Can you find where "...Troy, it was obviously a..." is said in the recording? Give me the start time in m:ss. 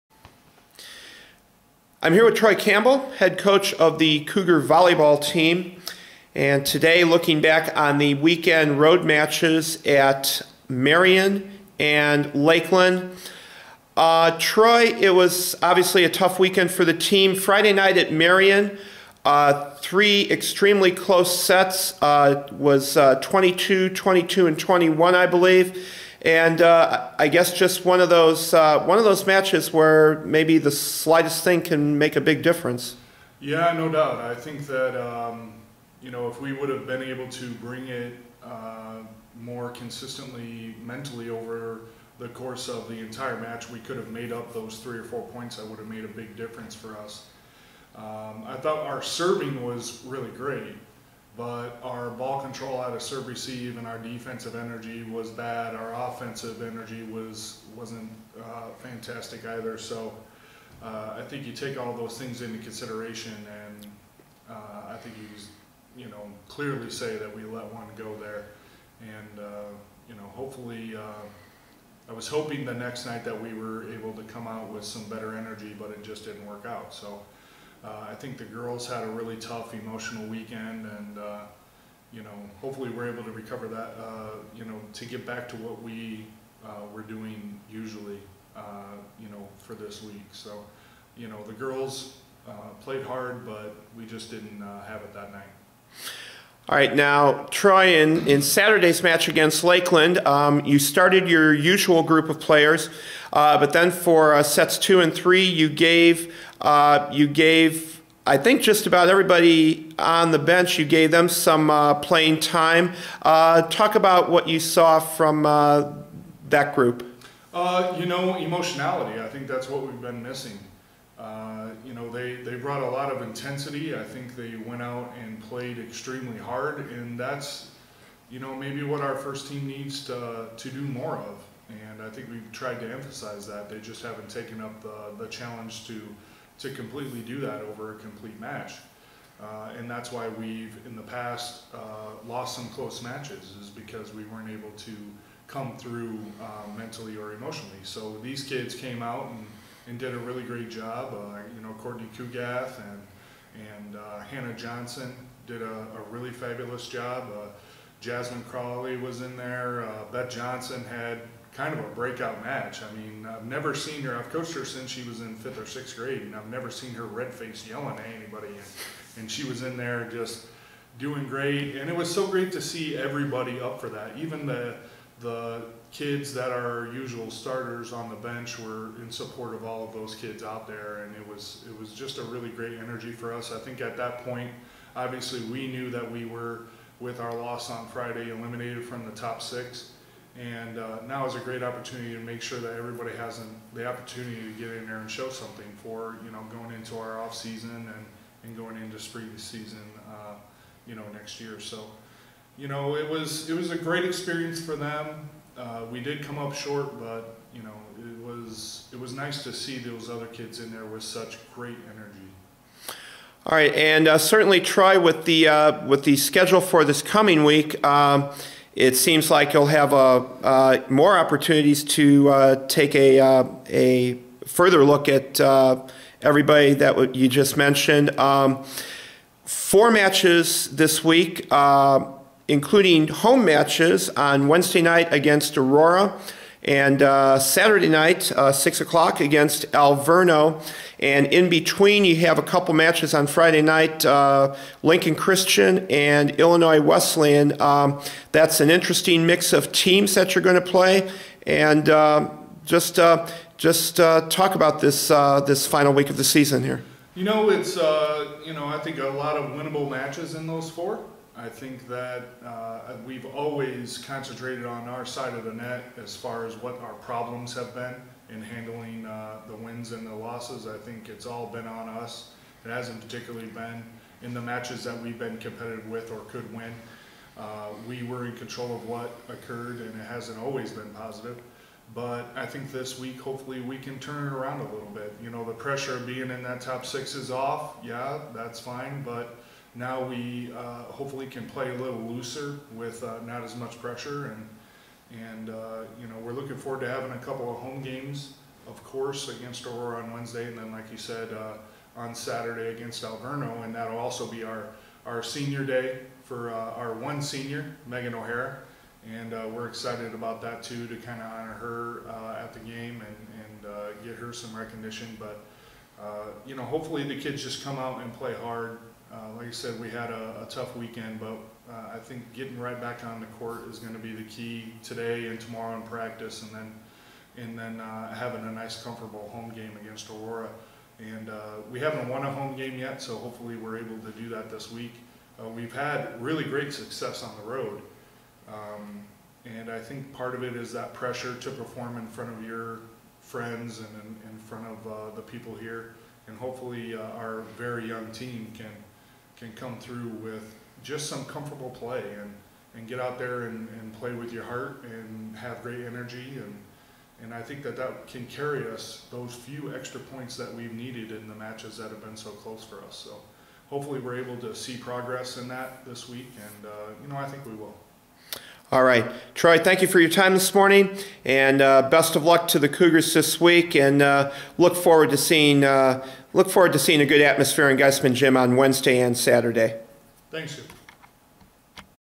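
0:14.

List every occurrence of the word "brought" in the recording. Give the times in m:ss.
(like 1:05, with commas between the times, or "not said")
2:02.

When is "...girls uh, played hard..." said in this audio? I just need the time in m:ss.
1:31.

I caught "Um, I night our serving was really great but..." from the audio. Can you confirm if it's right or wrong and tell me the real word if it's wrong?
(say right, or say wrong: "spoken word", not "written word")
wrong: "thought", not "night".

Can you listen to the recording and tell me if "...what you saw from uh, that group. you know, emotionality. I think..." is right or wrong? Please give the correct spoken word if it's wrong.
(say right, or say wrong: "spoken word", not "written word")
right.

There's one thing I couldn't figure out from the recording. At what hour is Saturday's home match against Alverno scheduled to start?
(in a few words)
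6 o'clock.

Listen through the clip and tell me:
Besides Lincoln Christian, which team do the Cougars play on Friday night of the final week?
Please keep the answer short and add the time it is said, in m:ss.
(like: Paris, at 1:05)
Illinois Wesleyan, at 4:06.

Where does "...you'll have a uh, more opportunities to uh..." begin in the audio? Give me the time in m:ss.
3:39.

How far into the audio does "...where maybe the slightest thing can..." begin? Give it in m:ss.
0:29.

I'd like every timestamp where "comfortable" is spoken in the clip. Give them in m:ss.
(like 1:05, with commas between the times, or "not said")
5:28, 5:51.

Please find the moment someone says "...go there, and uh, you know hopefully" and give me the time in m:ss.
1:07.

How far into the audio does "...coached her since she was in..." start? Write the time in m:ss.
2:44.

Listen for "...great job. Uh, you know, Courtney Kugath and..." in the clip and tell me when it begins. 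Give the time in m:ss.
2:30.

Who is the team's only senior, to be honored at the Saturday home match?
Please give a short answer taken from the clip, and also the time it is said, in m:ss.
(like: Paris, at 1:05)
Megan O'Hara, at 5:07.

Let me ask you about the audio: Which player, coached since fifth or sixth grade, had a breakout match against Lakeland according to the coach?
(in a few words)
Beth Johnson.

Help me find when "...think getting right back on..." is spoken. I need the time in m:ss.
5:21.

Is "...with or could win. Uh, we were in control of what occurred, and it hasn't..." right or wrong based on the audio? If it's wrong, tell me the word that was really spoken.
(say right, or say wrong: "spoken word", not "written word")
right.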